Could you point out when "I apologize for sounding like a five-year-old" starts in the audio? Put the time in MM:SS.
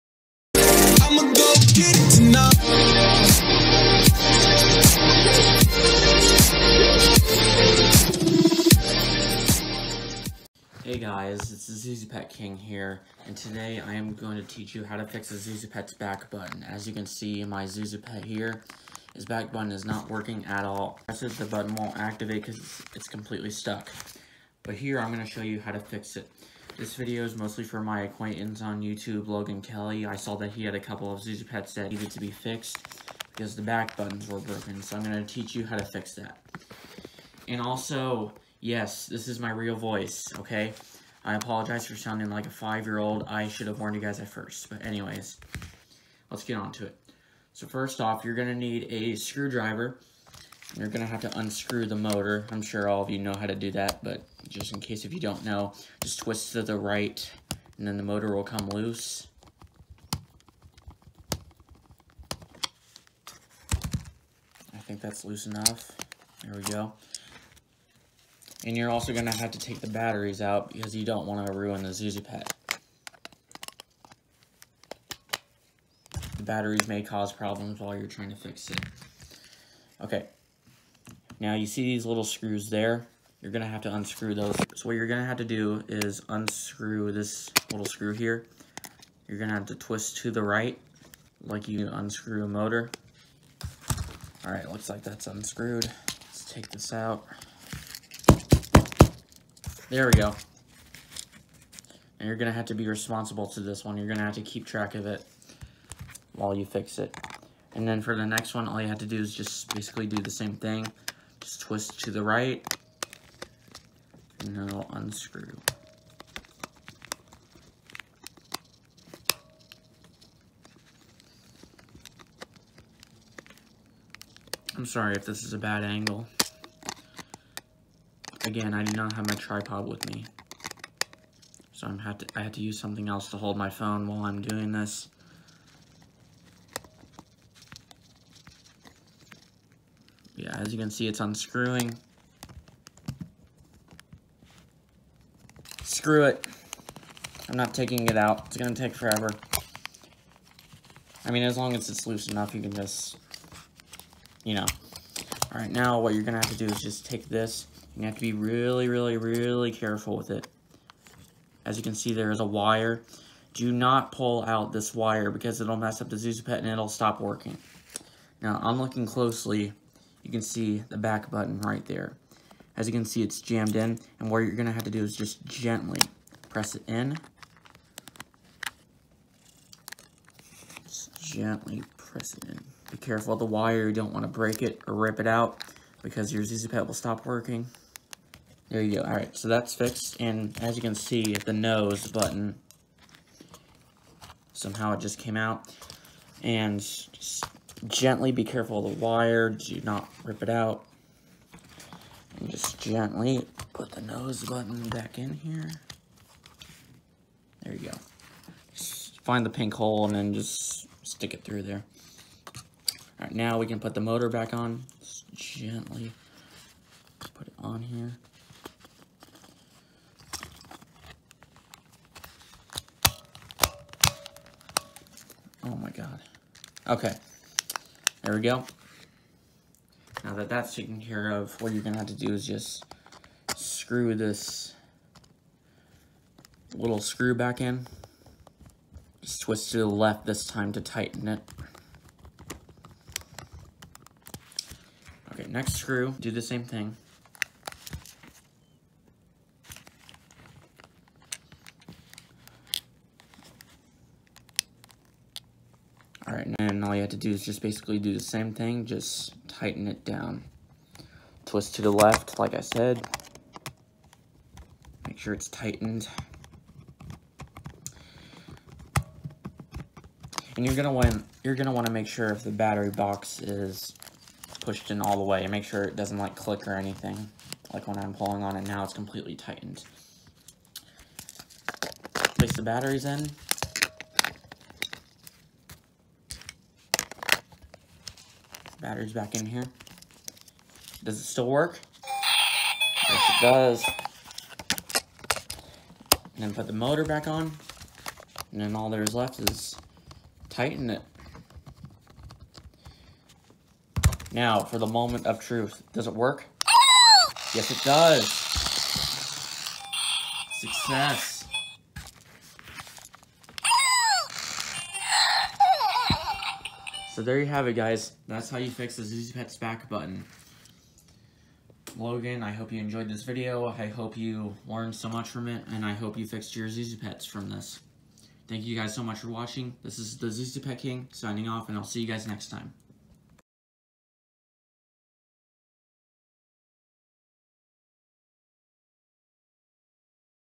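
00:41.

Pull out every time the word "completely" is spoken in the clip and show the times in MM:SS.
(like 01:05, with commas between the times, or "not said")
00:23, 04:38.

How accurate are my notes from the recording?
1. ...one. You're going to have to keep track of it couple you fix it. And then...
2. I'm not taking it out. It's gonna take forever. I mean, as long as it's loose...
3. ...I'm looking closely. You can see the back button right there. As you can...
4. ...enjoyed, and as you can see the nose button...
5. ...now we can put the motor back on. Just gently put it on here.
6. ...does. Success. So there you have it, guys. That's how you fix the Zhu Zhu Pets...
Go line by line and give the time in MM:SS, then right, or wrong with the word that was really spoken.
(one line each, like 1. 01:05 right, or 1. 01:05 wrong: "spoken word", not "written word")
1. 01:43 wrong: "while", not "couple"
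2. 02:27 right
3. 02:48 right
4. 03:09 wrong: "fixed", not "enjoyed"
5. 03:33 right
6. 05:07 right.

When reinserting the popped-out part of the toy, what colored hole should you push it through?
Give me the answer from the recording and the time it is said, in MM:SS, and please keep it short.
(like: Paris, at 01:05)
pink, at 03:29.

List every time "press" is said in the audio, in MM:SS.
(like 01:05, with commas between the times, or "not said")
02:56, 03:01.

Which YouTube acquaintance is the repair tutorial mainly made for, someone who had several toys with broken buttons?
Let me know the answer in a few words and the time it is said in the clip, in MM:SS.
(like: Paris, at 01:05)
Logan Kelly, at 00:29.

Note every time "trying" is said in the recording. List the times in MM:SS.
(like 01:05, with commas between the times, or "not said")
01:18.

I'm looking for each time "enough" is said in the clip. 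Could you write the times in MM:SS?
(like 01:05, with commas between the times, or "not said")
01:05, 02:32.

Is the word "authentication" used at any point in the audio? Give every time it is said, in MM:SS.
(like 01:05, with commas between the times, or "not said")
not said.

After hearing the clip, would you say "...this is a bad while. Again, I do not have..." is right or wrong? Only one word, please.
wrong.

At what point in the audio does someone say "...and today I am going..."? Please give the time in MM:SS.
00:13.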